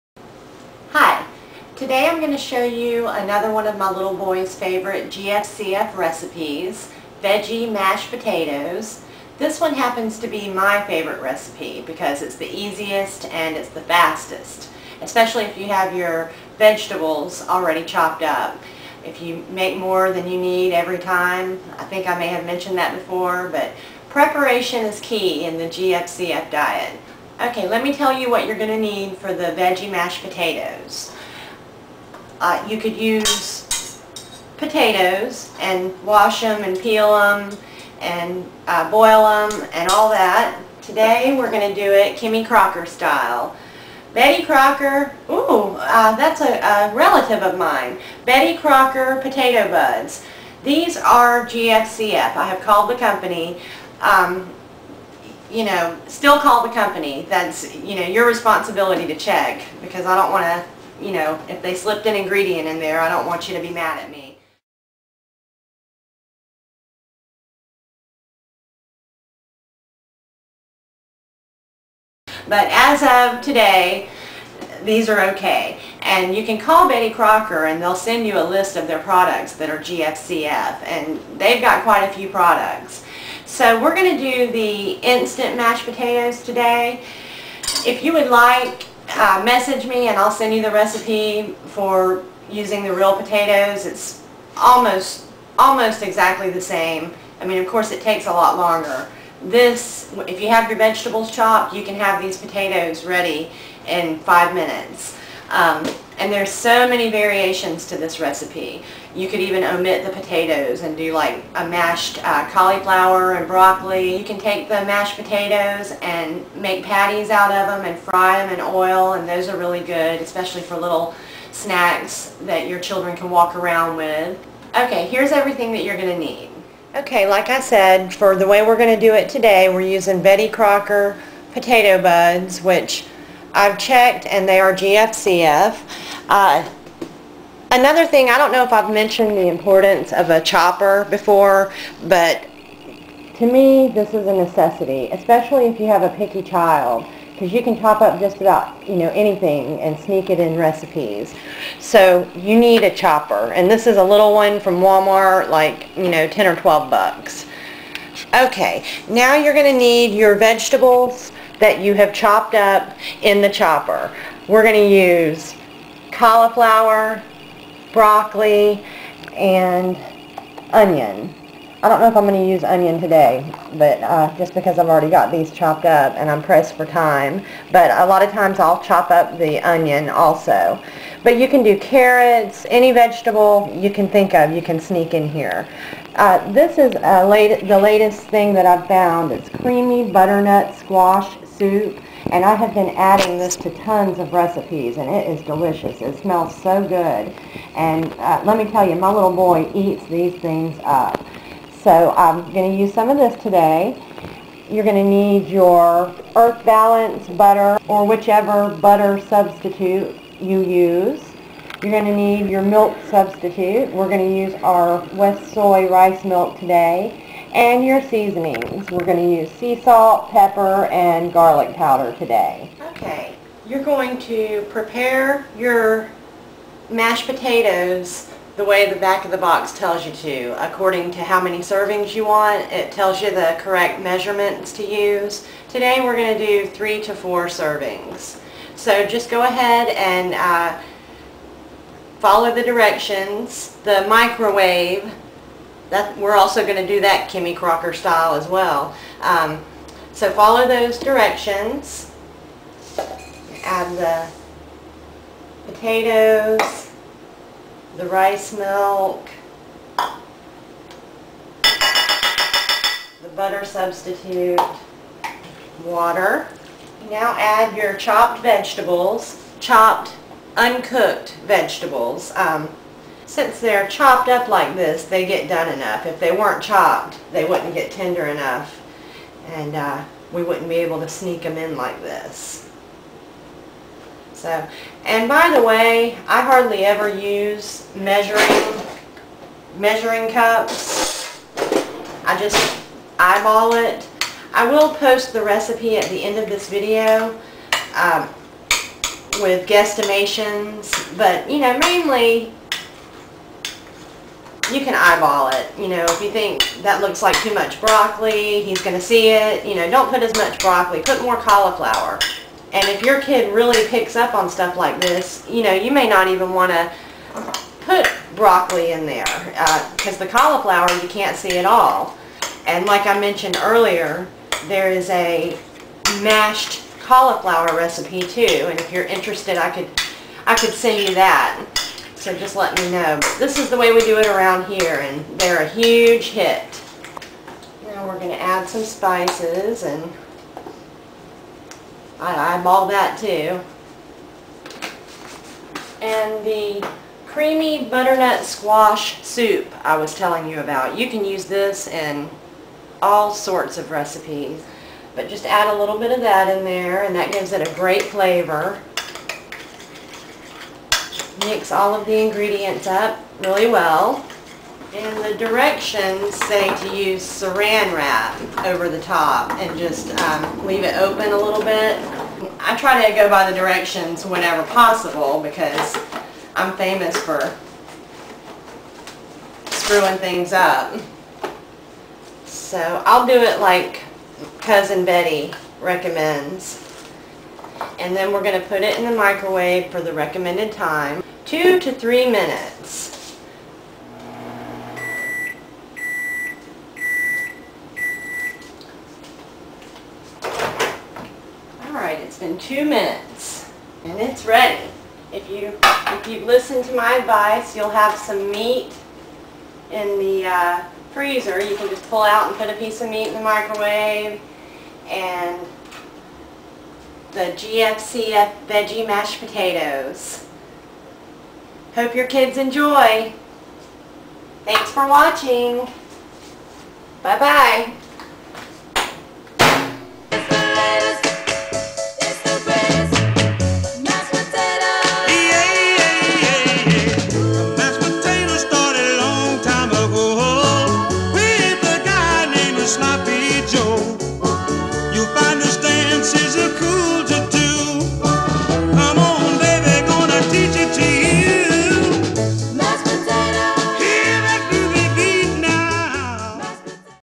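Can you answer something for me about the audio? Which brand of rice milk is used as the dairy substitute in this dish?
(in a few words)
WestSoy.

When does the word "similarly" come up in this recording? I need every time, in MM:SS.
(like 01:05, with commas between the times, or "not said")
not said.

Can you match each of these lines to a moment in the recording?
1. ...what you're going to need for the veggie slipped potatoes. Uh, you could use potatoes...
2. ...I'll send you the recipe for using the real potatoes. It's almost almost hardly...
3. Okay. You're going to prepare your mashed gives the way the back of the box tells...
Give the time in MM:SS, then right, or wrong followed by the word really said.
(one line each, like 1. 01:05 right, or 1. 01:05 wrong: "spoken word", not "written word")
1. 00:28 wrong: "mashed", not "slipped"
2. 01:30 wrong: "exactly", not "hardly"
3. 03:42 wrong: "potatoes", not "gives".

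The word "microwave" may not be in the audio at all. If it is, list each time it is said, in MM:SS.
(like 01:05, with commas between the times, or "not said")
04:04, 06:29, 06:53.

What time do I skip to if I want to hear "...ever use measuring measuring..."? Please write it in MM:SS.
04:46.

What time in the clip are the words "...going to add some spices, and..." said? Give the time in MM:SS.
05:38.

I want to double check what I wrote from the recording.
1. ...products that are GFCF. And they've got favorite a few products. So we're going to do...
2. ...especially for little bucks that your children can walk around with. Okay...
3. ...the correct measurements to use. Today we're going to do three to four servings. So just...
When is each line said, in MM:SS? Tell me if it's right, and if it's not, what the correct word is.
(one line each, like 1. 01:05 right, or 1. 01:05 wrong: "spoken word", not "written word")
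1. 01:18 wrong: "quite", not "favorite"
2. 02:00 wrong: "snacks", not "bucks"
3. 03:53 right.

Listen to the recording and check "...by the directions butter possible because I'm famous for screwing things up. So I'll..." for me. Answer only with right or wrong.
wrong.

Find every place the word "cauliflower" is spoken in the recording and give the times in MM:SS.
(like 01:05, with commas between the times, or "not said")
01:52, 02:46, 05:11, 05:20, 05:27.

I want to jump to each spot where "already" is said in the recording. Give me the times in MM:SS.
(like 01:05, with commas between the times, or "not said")
00:17, 02:54.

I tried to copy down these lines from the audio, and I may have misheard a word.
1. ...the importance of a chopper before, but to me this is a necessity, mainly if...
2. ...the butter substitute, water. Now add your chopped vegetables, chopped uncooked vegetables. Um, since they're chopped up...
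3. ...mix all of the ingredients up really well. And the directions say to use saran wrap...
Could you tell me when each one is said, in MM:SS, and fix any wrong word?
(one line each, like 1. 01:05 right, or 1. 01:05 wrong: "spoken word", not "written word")
1. 02:19 wrong: "especially", not "mainly"
2. 04:21 right
3. 06:01 right.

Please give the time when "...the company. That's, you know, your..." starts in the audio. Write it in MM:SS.
00:56.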